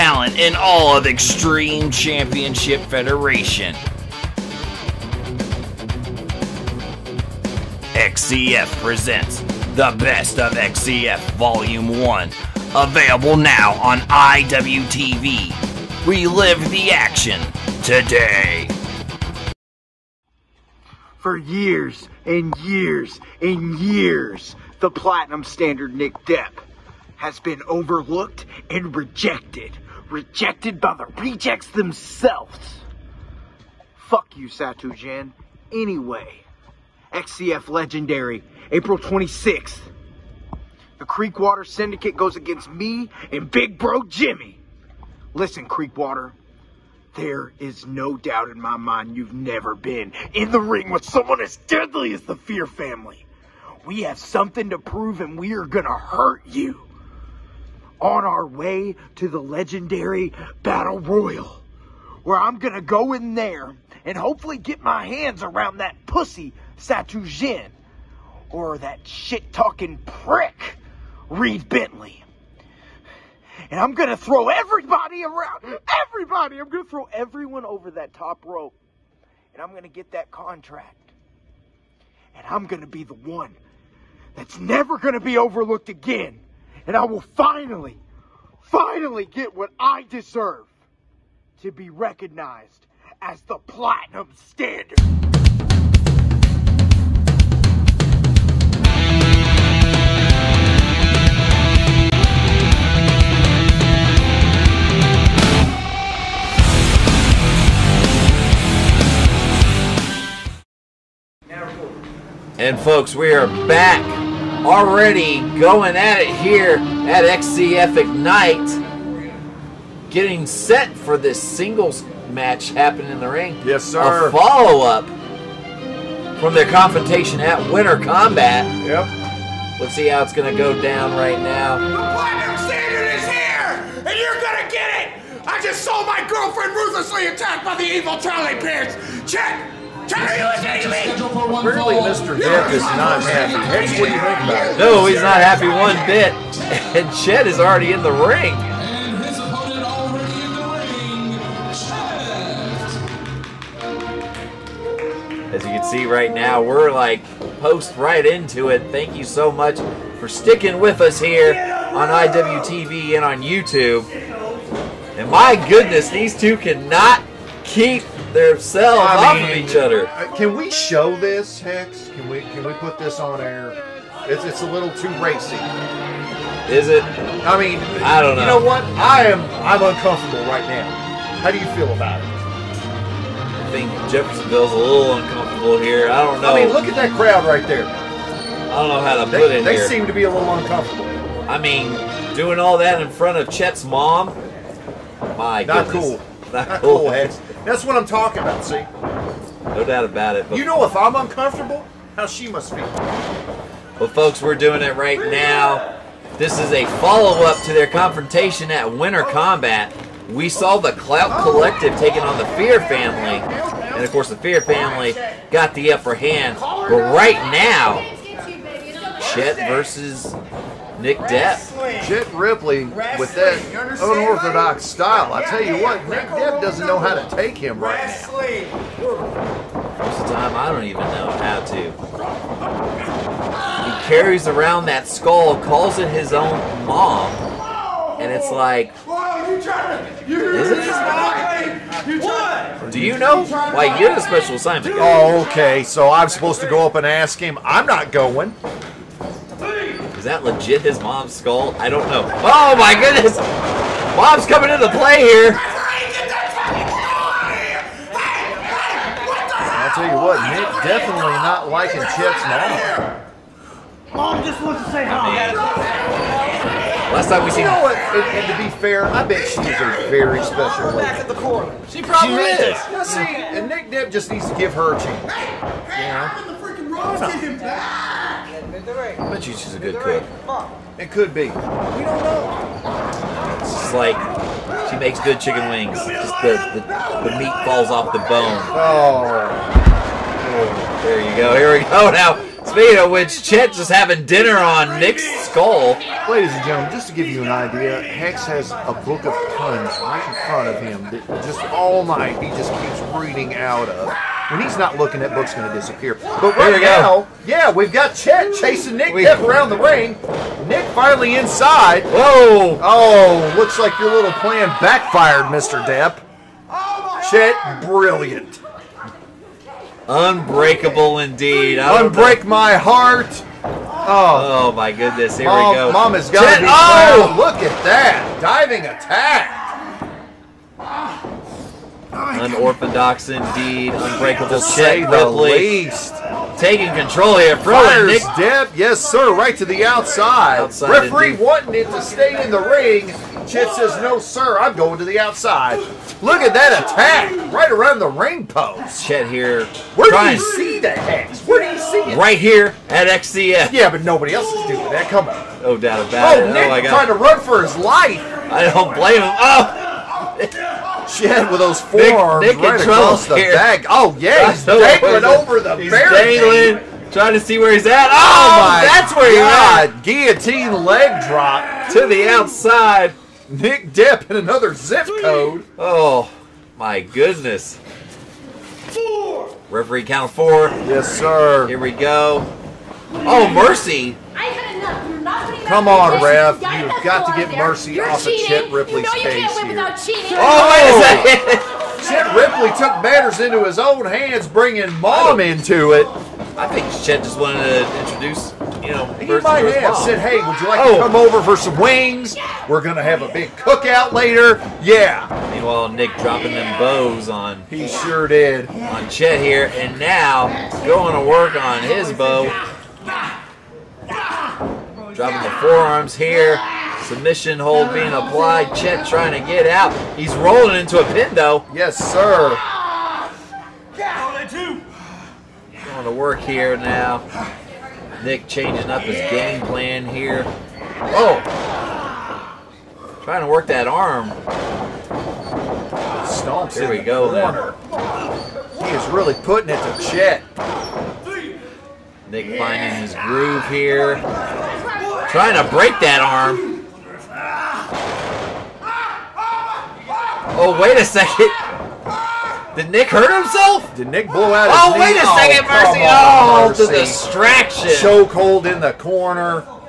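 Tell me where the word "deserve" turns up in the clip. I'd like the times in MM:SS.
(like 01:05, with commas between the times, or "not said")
01:30.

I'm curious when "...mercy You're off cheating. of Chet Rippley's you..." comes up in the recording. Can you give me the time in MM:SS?
06:27.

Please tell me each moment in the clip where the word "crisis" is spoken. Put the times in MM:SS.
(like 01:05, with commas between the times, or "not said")
not said.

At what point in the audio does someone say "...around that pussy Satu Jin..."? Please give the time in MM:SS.
01:05.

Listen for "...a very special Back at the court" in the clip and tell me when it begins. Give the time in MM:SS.
04:29.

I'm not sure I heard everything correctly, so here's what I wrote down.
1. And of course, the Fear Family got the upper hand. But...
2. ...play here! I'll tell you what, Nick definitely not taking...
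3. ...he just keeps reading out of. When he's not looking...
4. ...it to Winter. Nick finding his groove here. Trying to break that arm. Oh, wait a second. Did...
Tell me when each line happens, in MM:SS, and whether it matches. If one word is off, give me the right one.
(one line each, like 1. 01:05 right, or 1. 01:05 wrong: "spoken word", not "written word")
1. 03:33 right
2. 04:14 wrong: "liking", not "taking"
3. 05:02 right
4. 07:19 wrong: "Chet", not "Winter".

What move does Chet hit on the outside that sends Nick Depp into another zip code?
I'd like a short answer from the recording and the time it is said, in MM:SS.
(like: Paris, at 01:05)
guillotine leg drop, at 06:10.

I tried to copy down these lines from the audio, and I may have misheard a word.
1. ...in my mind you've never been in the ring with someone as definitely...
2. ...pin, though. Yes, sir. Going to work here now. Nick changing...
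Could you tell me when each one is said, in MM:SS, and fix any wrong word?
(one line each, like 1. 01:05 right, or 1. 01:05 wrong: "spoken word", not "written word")
1. 00:48 wrong: "deadly", not "definitely"
2. 07:01 right.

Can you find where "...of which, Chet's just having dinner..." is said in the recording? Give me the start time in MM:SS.
04:52.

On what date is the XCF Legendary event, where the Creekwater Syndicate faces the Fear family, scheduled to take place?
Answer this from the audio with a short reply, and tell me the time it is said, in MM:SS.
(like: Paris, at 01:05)
April 26th, at 00:38.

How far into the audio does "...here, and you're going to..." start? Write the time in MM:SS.
02:13.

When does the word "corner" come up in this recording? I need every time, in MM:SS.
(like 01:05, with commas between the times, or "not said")
07:38.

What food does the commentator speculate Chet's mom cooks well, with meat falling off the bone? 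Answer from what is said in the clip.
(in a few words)
chicken wings.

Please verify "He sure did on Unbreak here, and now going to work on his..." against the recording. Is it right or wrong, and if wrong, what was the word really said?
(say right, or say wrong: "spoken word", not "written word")
wrong: "Chet", not "Unbreak".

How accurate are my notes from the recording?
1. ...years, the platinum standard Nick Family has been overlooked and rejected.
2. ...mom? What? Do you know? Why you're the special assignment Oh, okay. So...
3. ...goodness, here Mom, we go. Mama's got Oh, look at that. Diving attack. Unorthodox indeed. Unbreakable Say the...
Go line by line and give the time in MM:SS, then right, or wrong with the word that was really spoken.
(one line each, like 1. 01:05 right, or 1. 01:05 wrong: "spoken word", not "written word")
1. 00:23 wrong: "Depp", not "Family"
2. 04:00 right
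3. 05:24 right.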